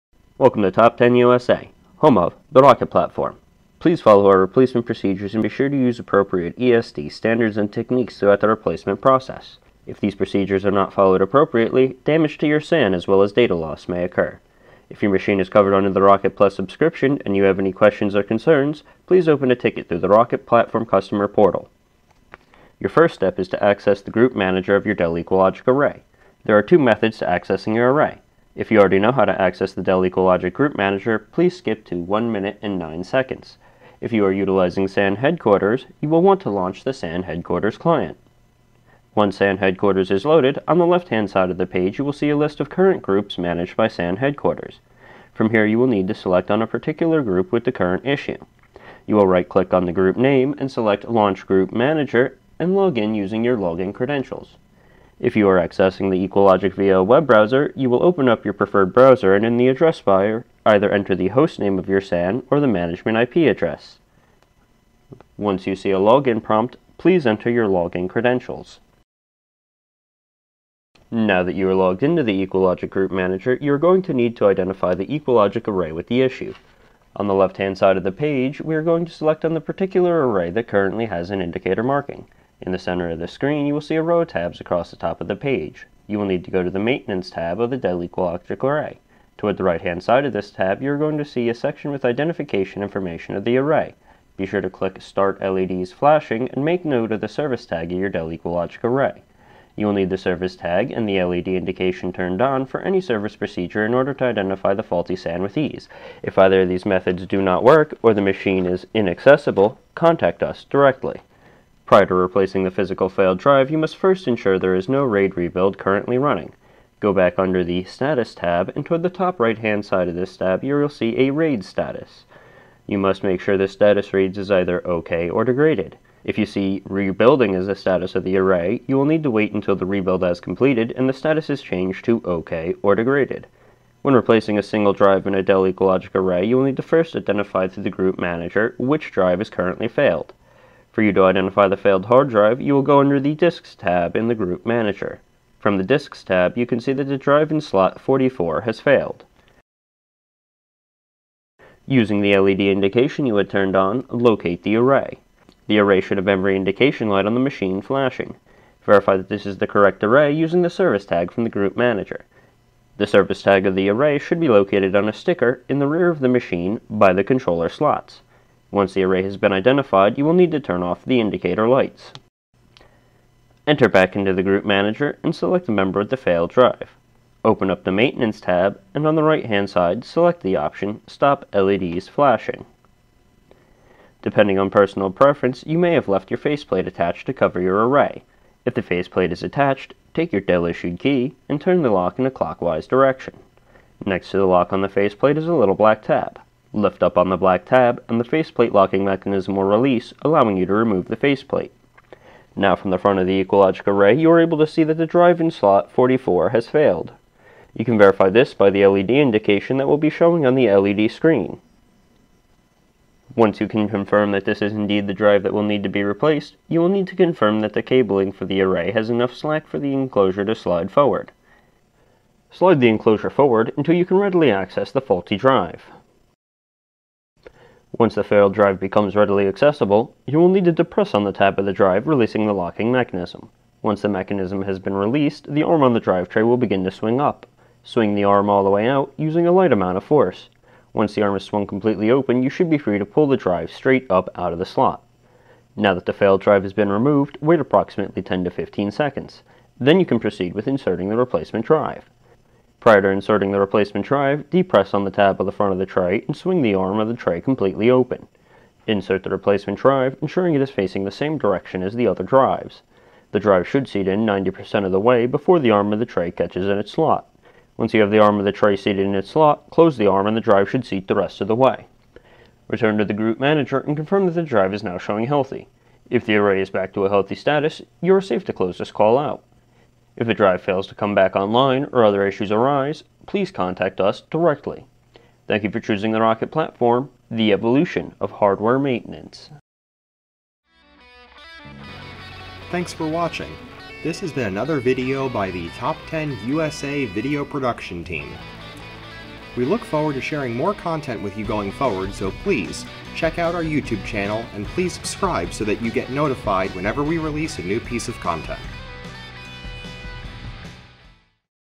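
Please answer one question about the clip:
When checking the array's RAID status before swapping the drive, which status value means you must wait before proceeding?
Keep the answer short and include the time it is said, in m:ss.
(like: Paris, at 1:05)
rebuilding, at 2:06.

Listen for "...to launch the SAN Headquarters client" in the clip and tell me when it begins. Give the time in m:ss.
0:36.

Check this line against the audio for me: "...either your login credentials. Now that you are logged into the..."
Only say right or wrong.
wrong.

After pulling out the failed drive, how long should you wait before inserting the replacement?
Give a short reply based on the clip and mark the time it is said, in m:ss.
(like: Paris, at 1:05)
10 to 15 seconds, at 4:08.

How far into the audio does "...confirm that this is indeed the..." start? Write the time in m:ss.
3:33.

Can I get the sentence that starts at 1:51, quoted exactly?
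Prior to replacing the physical failed drive, you must first ensure there is no RAID rebuild currently running.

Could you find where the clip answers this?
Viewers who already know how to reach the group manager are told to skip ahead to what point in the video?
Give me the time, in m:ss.
0:31.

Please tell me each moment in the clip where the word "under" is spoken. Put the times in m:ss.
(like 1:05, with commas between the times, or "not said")
0:15, 1:57, 2:22.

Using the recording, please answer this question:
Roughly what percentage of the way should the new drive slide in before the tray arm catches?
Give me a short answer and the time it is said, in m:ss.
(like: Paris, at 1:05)
90%, at 4:24.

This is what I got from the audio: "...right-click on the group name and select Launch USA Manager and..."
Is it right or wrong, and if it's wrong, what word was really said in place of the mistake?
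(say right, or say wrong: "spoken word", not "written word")
wrong: "Group", not "USA".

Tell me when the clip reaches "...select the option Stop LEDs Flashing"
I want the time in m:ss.
3:00.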